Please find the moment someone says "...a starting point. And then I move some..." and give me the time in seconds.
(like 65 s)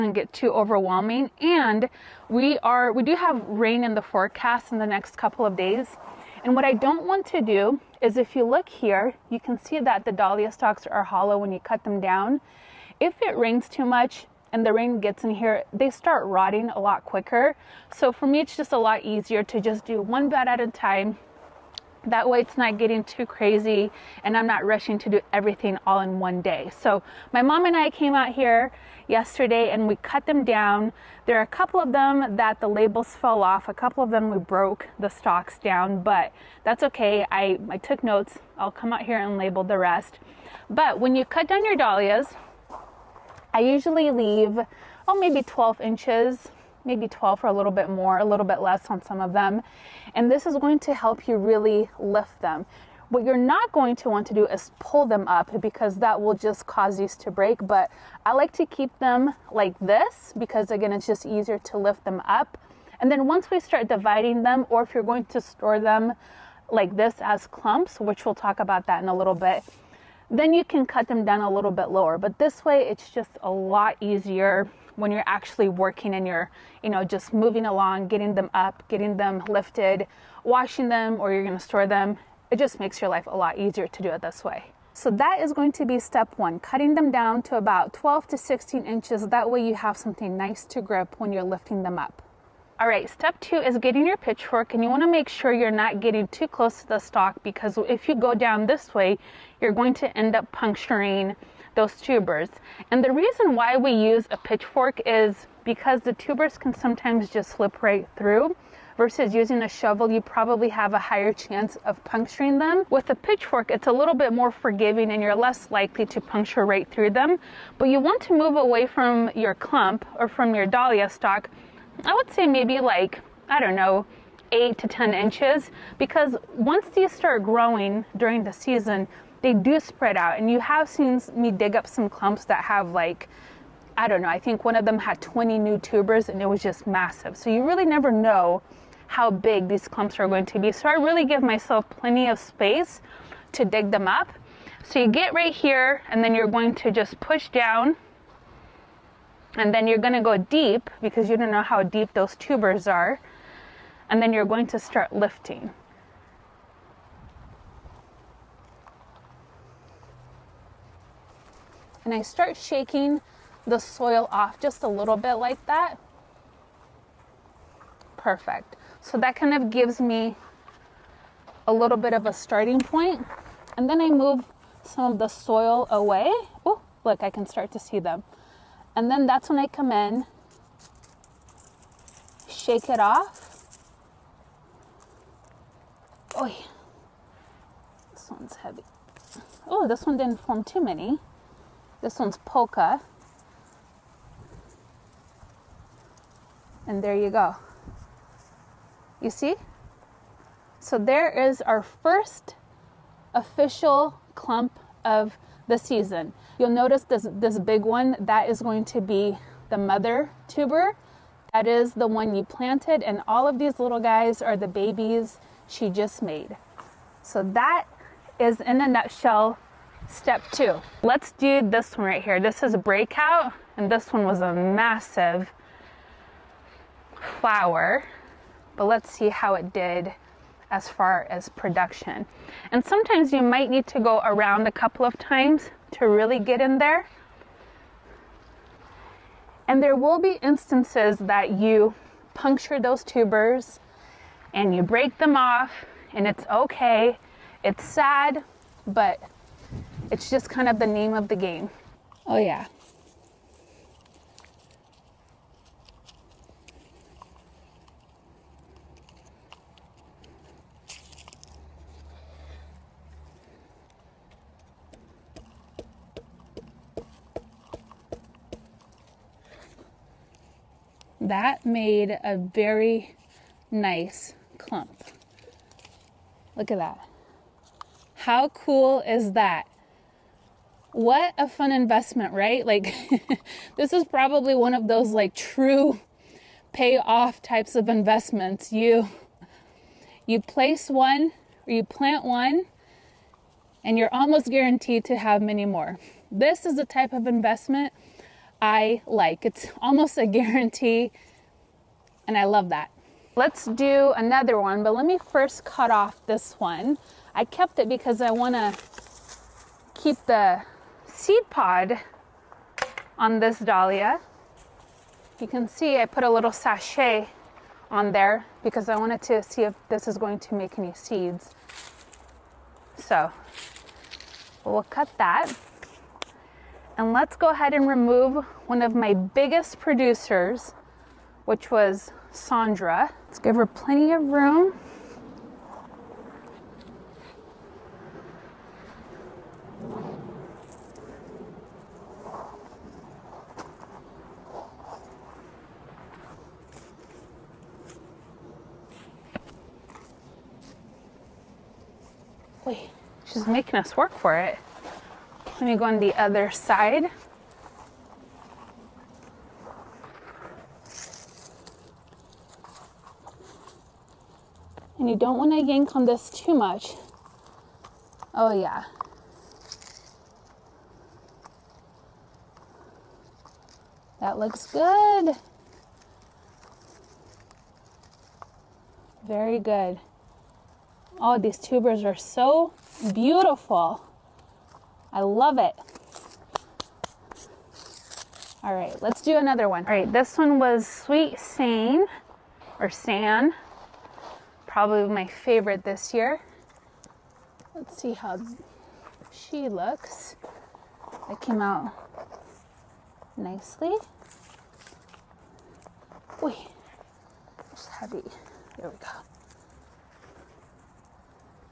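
172 s.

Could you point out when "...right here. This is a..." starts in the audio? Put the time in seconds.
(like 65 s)
222 s.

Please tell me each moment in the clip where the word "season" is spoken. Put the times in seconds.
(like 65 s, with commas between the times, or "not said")
128 s, 205 s.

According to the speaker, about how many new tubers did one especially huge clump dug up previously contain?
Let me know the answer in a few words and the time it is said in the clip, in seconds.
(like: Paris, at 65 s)
20, at 135 s.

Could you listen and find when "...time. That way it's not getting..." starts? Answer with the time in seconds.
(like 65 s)
20 s.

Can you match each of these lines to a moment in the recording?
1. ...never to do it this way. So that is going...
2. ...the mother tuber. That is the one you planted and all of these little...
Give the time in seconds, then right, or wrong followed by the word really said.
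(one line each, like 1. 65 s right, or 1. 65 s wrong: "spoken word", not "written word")
1. 83 s wrong: "easier", not "never"
2. 209 s right.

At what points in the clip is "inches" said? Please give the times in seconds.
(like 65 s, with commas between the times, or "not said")
45 s, 88 s, 125 s.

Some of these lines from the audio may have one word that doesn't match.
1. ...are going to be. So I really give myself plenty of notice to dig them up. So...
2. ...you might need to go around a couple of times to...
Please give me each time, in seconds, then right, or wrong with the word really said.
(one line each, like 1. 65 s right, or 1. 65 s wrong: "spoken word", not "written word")
1. 140 s wrong: "space", not "notice"
2. 233 s right.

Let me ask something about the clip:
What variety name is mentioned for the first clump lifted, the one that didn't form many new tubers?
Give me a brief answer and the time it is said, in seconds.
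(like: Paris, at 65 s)
Polka, at 192 s.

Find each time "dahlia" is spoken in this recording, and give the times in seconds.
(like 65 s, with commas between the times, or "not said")
10 s, 41 s, 120 s, 313 s.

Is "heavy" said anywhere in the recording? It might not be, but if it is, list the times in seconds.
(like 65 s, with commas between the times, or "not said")
188 s, 407 s.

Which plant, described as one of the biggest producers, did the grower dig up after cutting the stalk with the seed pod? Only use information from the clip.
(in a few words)
Sandra.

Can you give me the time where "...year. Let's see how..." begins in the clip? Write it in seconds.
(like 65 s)
396 s.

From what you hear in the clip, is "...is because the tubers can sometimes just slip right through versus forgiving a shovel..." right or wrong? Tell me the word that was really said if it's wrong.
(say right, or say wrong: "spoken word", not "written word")
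wrong: "using", not "forgiving".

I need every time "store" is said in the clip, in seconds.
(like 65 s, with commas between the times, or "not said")
65 s, 81 s.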